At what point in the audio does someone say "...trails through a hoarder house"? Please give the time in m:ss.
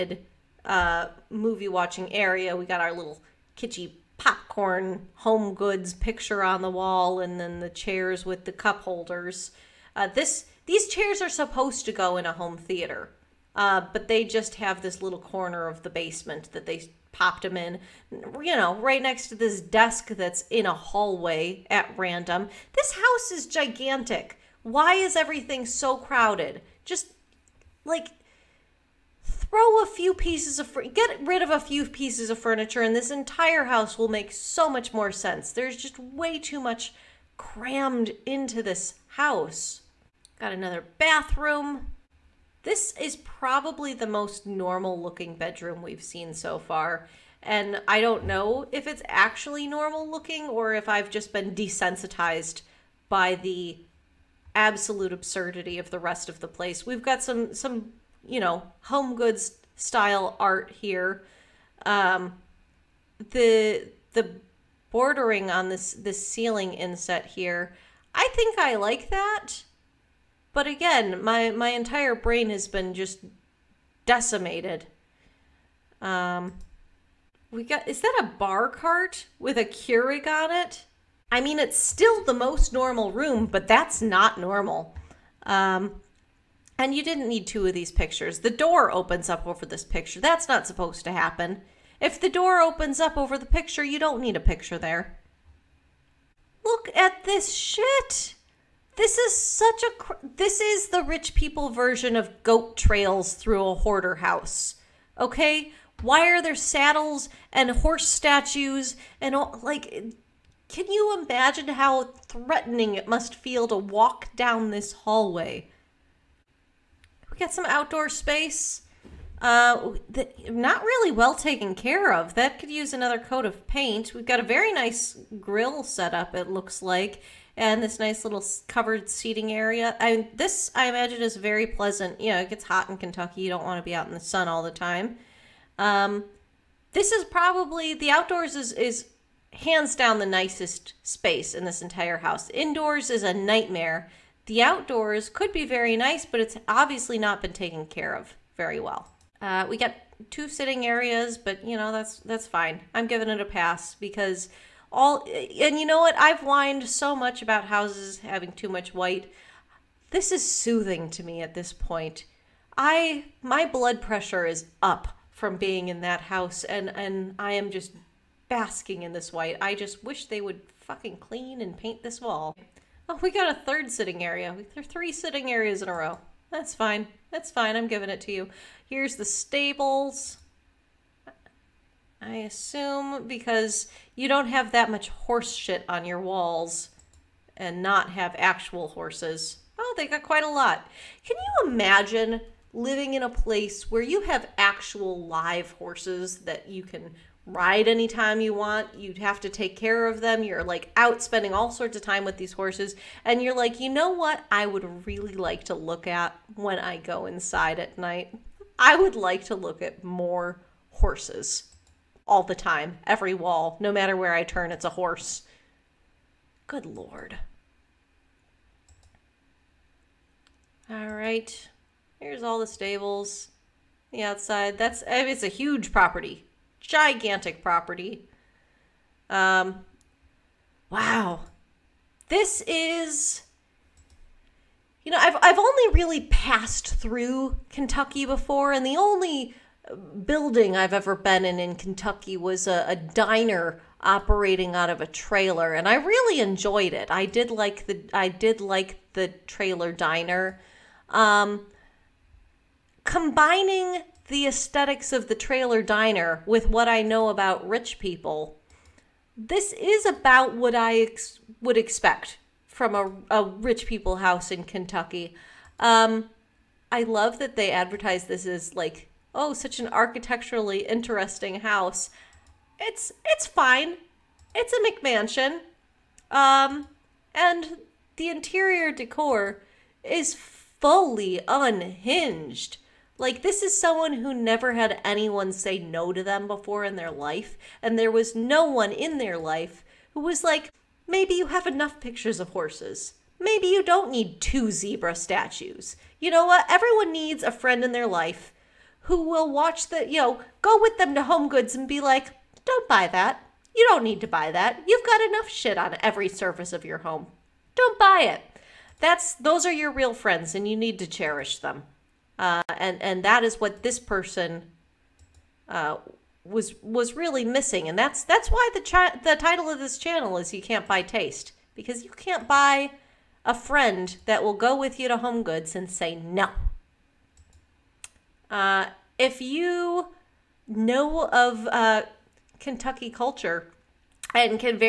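1:42.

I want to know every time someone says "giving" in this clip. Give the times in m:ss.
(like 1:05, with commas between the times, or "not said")
2:33, 2:57.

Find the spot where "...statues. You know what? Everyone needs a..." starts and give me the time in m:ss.
4:55.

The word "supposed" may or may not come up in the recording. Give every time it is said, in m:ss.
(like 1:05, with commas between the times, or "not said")
0:11, 1:30.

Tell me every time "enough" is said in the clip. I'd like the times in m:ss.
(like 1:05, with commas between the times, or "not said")
4:51, 5:05.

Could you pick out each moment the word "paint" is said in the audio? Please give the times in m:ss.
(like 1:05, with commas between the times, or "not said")
2:03, 2:51.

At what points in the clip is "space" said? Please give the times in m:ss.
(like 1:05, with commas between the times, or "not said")
1:58, 2:21.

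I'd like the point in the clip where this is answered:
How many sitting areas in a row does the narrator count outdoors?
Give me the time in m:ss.
2:54.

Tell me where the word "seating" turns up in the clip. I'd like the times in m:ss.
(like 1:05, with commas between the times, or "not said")
2:09.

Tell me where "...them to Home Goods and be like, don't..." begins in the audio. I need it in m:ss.
5:00.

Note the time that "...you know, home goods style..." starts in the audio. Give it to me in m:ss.
0:58.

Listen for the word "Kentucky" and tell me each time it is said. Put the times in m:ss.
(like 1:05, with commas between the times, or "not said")
2:12, 3:57, 4:01, 4:24, 5:32.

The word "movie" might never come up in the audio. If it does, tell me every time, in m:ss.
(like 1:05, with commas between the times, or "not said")
0:01.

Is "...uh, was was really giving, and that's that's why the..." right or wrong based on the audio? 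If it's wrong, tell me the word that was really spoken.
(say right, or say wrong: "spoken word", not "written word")
wrong: "missing", not "giving".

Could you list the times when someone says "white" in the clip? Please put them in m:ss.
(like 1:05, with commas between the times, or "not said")
2:38, 2:49.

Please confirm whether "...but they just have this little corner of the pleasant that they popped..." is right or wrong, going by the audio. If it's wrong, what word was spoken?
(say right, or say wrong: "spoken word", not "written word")
wrong: "basement", not "pleasant".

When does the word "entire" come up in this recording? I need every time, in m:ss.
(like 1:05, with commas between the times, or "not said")
0:33, 1:11, 2:21.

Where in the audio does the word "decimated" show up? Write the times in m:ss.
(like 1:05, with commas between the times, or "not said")
1:14.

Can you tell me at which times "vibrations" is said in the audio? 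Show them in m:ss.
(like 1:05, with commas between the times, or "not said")
not said.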